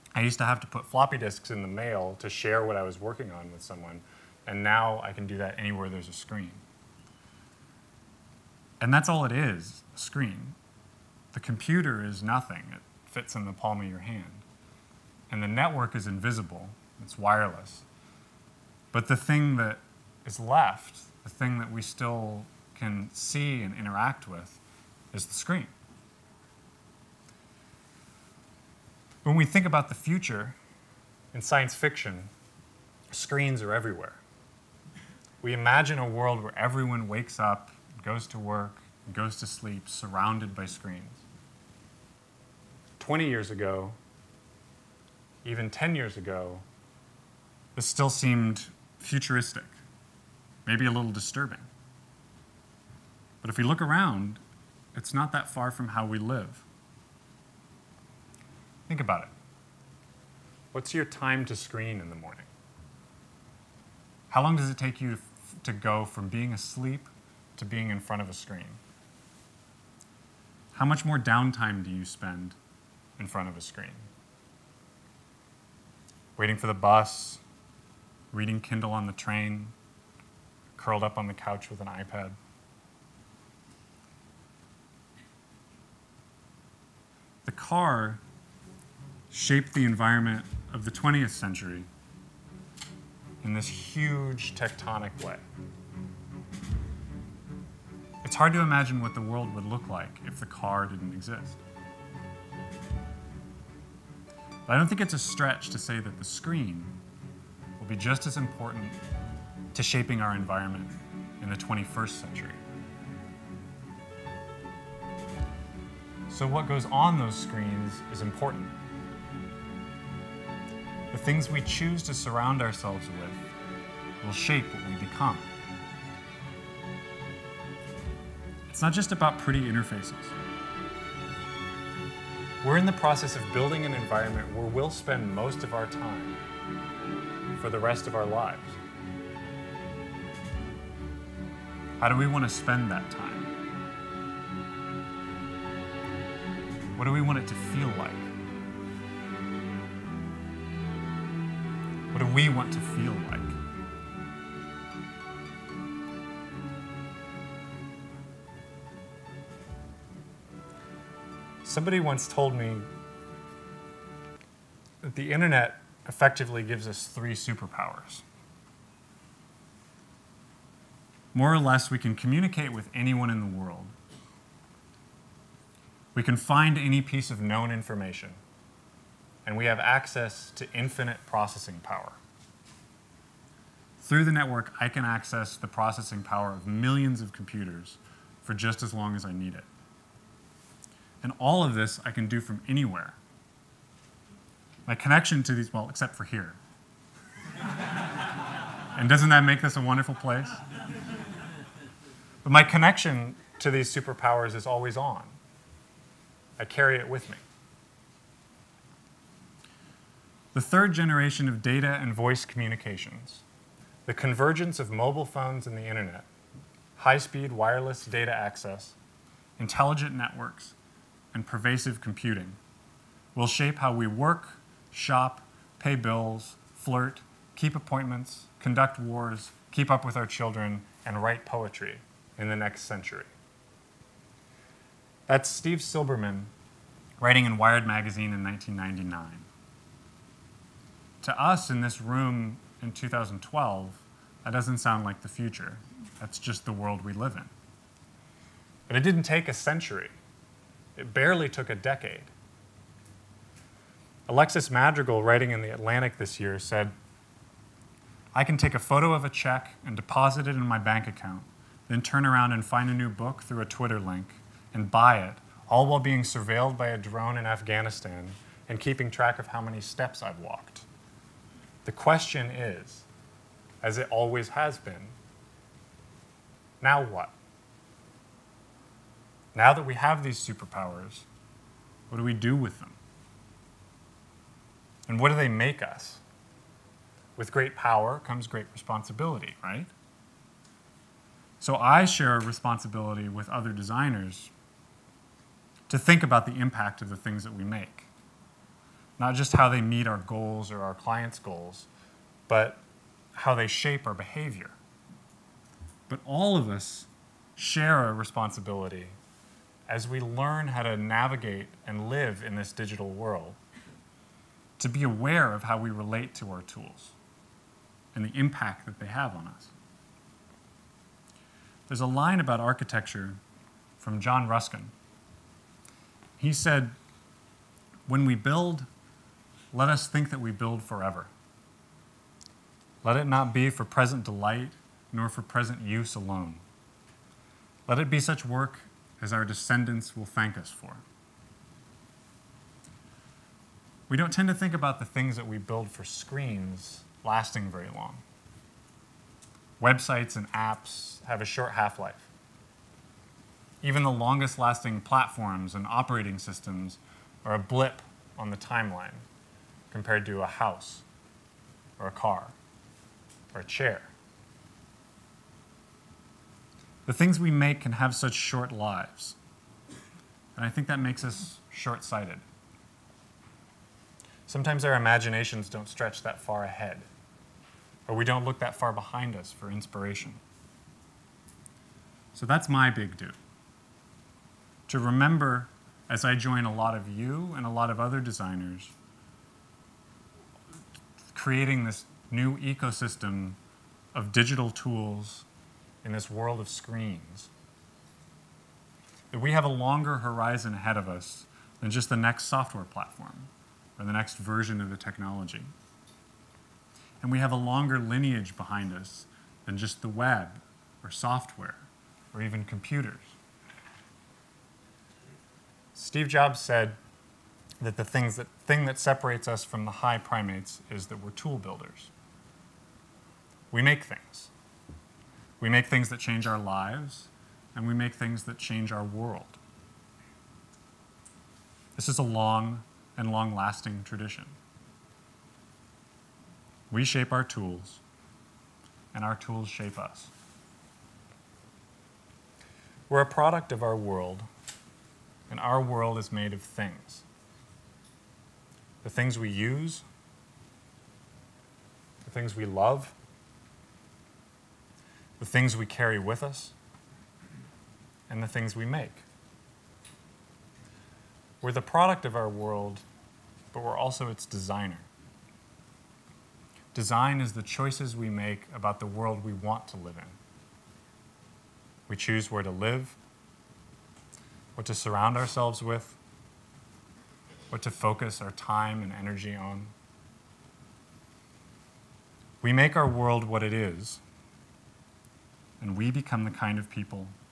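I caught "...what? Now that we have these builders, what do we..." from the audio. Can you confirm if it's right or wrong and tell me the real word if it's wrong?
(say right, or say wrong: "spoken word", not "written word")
wrong: "superpowers", not "builders".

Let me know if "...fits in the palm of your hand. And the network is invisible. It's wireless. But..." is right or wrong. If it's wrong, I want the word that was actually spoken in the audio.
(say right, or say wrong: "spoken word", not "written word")
right.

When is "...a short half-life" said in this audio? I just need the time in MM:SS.
05:51.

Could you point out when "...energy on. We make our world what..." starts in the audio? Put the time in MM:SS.
07:59.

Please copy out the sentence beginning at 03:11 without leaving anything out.
And all of this I can do from anywhere my connection to these, well, except for here.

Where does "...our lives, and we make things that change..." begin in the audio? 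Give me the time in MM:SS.
07:06.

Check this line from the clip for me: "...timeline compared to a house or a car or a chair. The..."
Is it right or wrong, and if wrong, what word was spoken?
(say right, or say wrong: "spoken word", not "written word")
right.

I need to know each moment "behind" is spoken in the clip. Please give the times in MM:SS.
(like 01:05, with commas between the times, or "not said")
06:18, 06:48.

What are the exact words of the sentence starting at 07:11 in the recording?
This is a long and long lasting tradition.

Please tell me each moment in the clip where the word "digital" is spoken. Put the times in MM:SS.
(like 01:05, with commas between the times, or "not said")
05:12, 06:34.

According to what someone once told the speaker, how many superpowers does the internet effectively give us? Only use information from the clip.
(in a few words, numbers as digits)
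3.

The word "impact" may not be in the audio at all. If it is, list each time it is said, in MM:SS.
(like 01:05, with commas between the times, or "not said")
04:56, 05:18.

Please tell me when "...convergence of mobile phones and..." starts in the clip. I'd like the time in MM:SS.
03:34.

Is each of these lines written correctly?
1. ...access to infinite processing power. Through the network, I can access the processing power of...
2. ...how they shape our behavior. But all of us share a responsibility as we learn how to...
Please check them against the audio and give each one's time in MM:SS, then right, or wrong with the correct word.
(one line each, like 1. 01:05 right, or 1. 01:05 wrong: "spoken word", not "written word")
1. 02:59 right
2. 05:03 right.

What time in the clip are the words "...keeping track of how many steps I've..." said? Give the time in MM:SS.
04:28.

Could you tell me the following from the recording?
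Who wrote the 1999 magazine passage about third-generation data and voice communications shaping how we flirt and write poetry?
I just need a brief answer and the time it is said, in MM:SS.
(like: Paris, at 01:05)
Steve Silberman, at 03:55.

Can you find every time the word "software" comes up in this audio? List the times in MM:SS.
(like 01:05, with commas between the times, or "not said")
06:42, 06:51.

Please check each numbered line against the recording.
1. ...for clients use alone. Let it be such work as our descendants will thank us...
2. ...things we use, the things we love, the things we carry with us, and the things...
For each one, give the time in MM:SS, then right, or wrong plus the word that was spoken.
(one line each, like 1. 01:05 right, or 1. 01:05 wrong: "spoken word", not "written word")
1. 05:35 wrong: "present", not "clients"
2. 07:29 right.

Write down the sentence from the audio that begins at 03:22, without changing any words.
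But my connection to these superpowers is always on.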